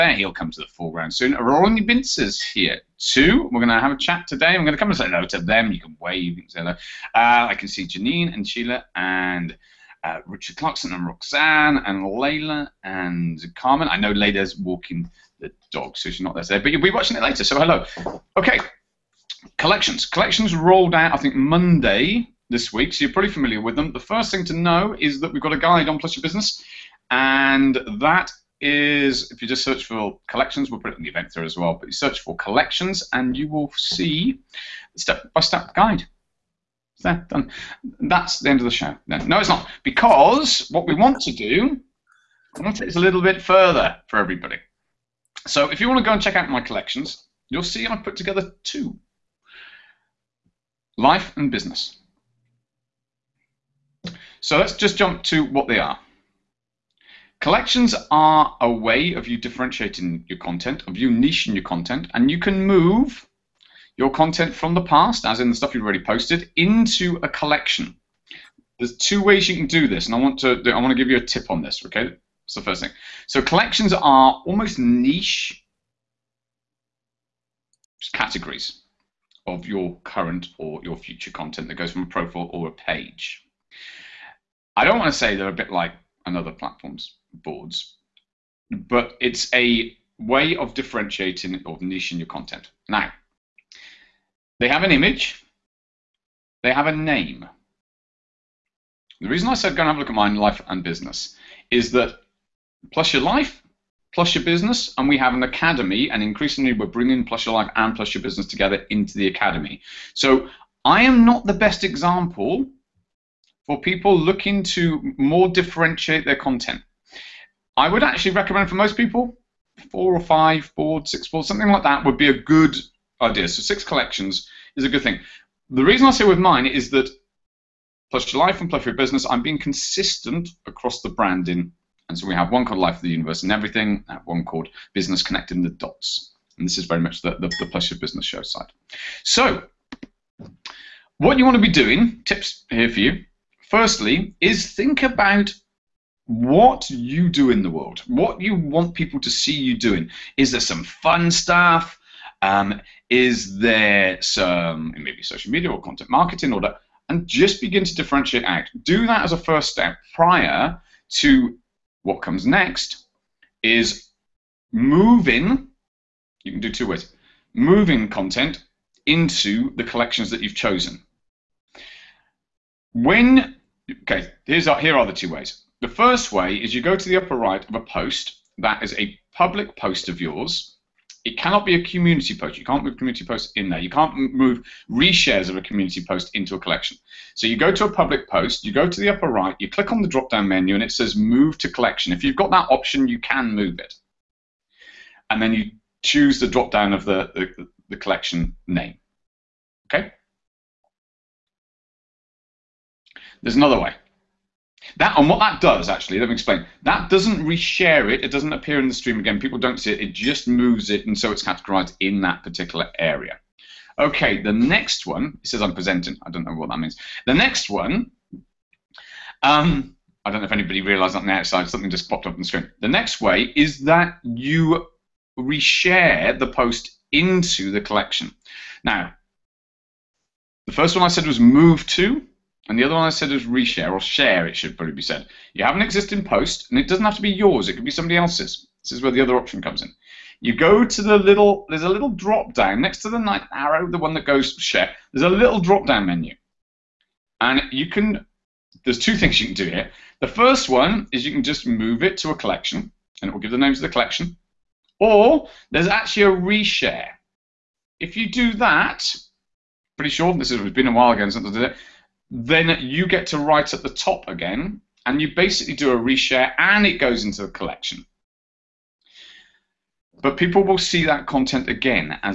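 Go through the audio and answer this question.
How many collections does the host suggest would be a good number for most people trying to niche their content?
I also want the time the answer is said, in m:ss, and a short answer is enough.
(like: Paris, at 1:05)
6, at 2:03.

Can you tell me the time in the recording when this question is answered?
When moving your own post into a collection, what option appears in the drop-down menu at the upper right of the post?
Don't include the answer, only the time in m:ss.
3:11.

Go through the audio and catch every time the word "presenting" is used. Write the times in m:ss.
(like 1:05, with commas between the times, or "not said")
3:35.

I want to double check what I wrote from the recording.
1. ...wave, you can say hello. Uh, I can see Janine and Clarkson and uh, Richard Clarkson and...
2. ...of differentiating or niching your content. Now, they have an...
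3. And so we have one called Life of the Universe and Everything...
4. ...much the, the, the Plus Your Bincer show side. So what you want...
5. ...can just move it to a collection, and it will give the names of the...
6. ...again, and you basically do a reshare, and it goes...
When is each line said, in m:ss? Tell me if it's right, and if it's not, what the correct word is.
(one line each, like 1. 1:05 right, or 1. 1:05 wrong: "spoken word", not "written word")
1. 0:05 wrong: "Sheila", not "Clarkson"
2. 1:30 right
3. 2:12 right
4. 2:16 wrong: "Business", not "Bincer"
5. 4:11 right
6. 4:24 right.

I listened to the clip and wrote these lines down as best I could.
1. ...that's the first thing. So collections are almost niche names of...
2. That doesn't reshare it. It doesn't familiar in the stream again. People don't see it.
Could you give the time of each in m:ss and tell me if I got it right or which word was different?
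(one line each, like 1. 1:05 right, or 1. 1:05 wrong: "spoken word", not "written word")
1. 1:12 wrong: "categories", not "names"
2. 3:26 wrong: "appear", not "familiar".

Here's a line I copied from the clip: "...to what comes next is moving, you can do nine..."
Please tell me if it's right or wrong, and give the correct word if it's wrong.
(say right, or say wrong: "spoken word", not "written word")
wrong: "two", not "nine".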